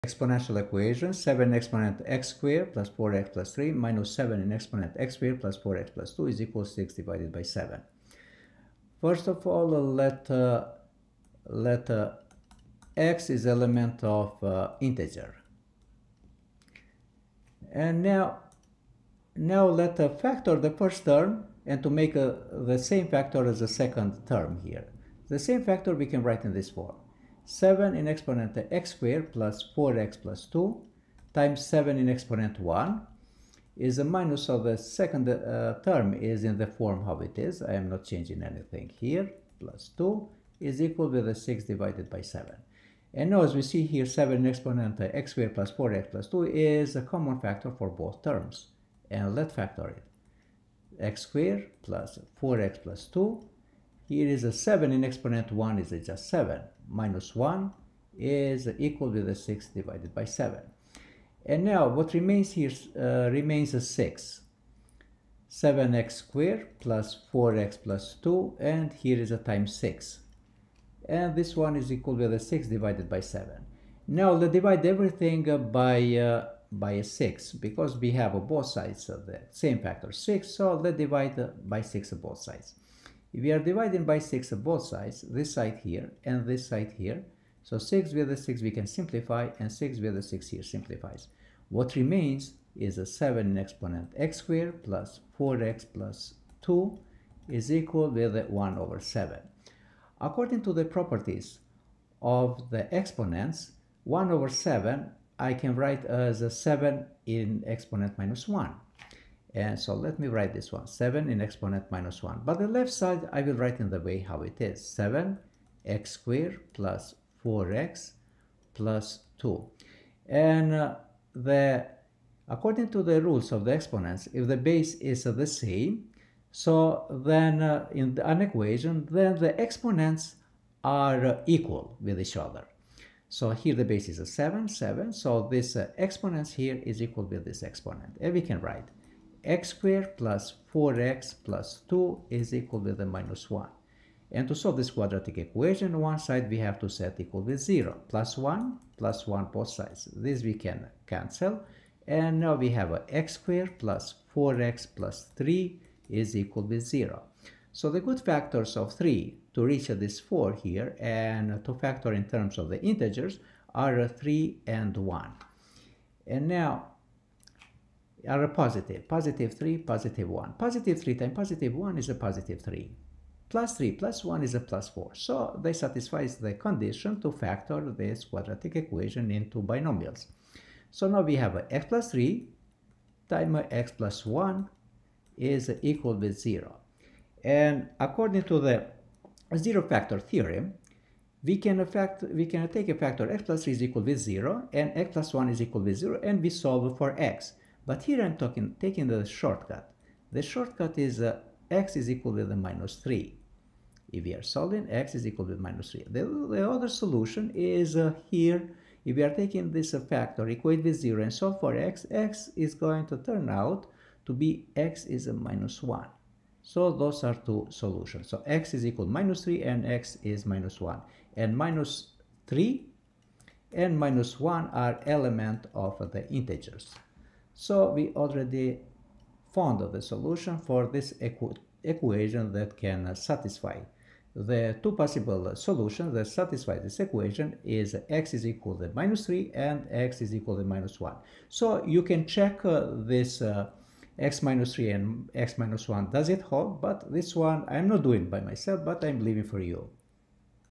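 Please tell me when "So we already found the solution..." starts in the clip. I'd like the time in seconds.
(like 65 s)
227 s.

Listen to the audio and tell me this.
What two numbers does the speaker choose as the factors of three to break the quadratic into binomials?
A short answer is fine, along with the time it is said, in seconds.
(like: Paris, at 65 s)
3 and 1, at 164 s.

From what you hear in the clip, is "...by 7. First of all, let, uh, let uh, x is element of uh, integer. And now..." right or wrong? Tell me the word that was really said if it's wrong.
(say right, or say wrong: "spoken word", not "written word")
right.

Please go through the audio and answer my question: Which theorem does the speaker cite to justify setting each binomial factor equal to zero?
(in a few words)
zero factor theorem.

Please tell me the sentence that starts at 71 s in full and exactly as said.
And this one is equal to the 6 divided by 7.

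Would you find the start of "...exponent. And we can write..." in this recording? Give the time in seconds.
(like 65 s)
137 s.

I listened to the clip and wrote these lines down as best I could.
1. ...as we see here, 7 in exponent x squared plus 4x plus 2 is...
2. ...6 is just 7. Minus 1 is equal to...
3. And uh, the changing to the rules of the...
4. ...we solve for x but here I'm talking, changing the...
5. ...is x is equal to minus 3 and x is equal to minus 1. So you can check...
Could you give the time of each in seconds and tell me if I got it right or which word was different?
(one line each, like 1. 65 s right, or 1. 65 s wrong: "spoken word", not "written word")
1. 43 s right
2. 55 s wrong: "1", not "6"
3. 120 s wrong: "according", not "changing"
4. 196 s wrong: "taking", not "changing"
5. 237 s right.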